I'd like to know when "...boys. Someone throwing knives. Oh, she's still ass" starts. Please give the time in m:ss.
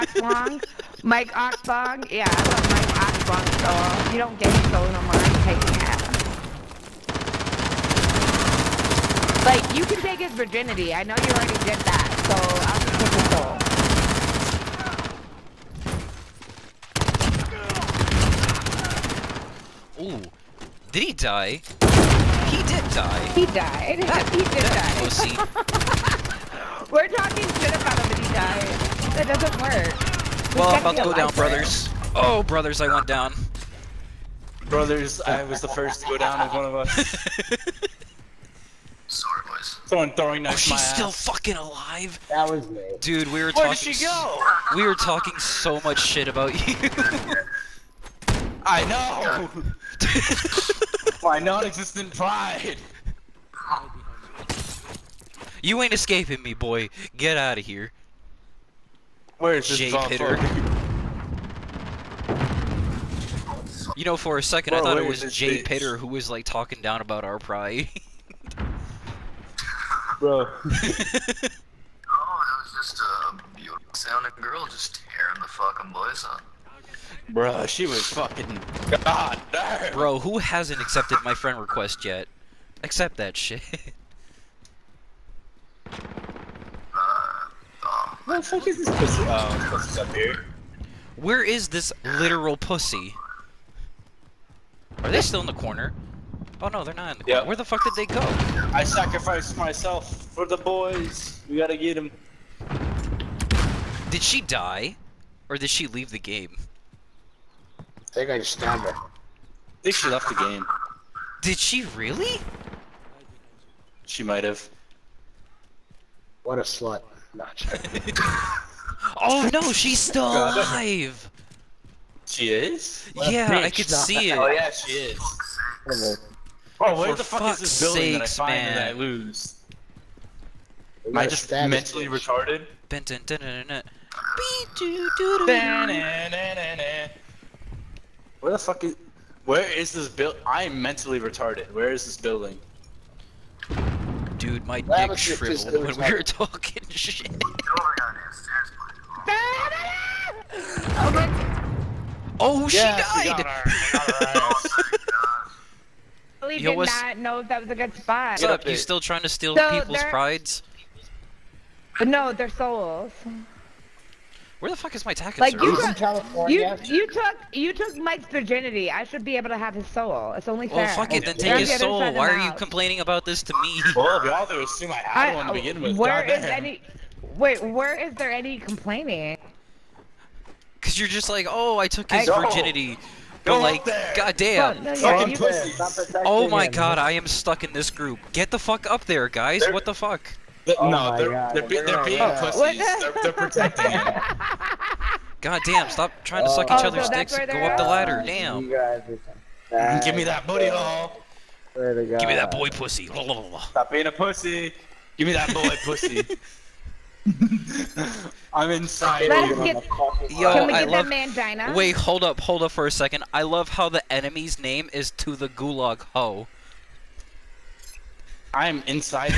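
0:39.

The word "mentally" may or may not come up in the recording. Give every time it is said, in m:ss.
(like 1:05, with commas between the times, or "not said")
2:11, 2:20.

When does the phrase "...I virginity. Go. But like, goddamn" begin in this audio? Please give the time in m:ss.
3:02.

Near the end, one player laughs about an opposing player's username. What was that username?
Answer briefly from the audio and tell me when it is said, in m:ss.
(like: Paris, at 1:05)
to the gulag ho, at 3:35.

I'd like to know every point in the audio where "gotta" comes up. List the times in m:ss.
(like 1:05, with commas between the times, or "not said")
1:41.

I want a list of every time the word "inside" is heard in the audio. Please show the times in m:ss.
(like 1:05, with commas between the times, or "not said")
3:28, 3:38.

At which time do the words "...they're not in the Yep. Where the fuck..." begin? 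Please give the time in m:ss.
1:36.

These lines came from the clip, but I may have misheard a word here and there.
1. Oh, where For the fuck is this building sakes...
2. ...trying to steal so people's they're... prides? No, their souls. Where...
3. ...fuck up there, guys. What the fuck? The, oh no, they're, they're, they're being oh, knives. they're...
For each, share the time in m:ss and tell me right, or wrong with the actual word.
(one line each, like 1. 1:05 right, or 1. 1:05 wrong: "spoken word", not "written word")
1. 2:06 right
2. 2:39 right
3. 3:08 wrong: "pussies", not "knives".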